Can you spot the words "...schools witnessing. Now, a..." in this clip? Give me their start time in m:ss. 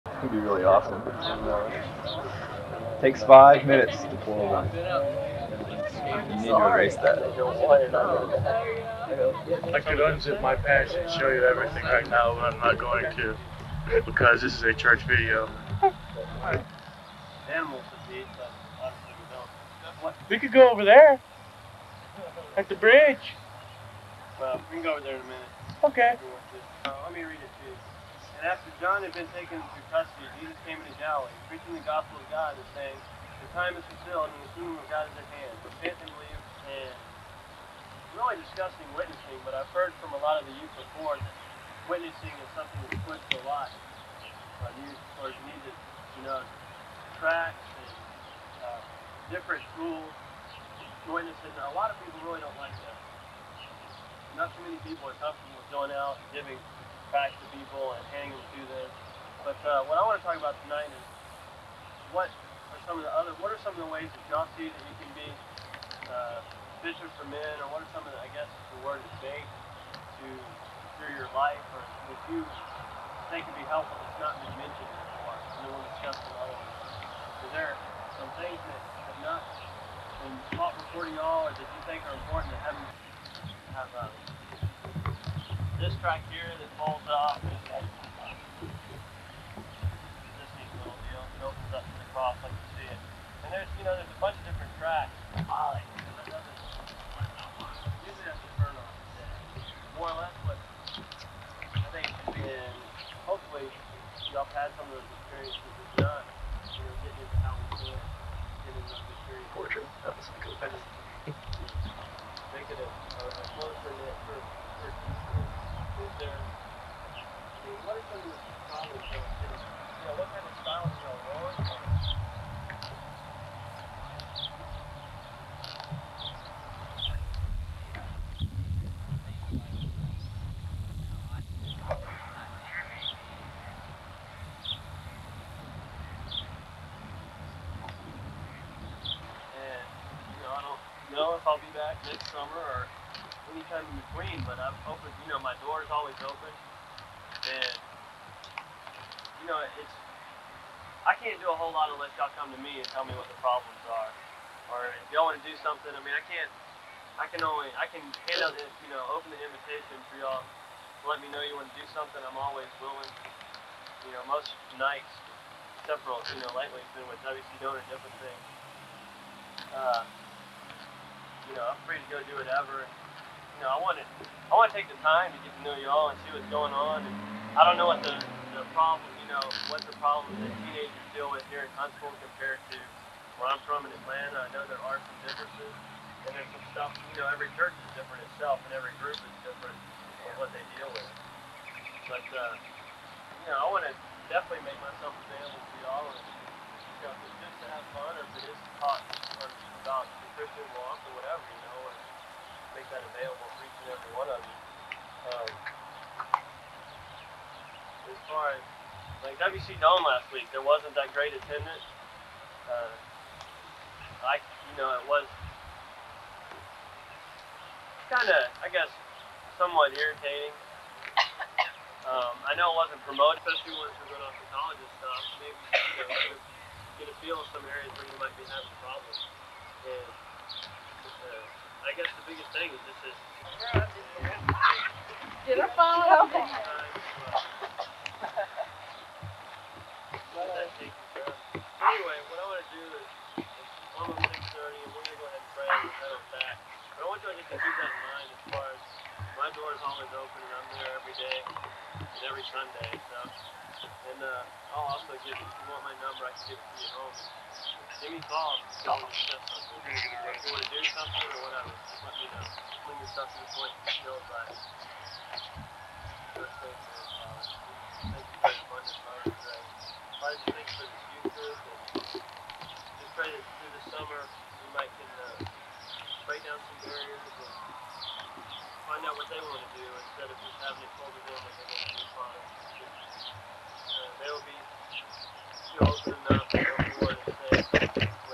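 0:49.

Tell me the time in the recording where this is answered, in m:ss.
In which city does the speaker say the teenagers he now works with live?
3:01.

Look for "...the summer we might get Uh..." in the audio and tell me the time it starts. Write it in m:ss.
4:33.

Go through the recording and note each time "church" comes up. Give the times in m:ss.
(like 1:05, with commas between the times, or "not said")
0:14, 3:07.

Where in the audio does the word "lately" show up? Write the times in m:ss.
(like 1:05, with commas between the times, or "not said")
2:46.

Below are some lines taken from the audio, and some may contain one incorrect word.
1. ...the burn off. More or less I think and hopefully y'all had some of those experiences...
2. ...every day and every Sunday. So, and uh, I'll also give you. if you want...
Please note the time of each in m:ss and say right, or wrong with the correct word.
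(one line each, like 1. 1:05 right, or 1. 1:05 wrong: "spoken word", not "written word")
1. 1:38 right
2. 4:11 right.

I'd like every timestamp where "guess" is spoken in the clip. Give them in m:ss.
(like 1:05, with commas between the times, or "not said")
1:08, 3:38, 3:51.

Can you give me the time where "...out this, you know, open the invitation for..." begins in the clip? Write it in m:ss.
2:38.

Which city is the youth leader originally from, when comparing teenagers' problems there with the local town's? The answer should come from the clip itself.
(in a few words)
Atlanta.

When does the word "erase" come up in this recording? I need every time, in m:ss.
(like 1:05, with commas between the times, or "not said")
0:06.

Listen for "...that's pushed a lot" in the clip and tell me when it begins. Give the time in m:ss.
0:42.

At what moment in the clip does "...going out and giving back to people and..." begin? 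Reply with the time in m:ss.
0:55.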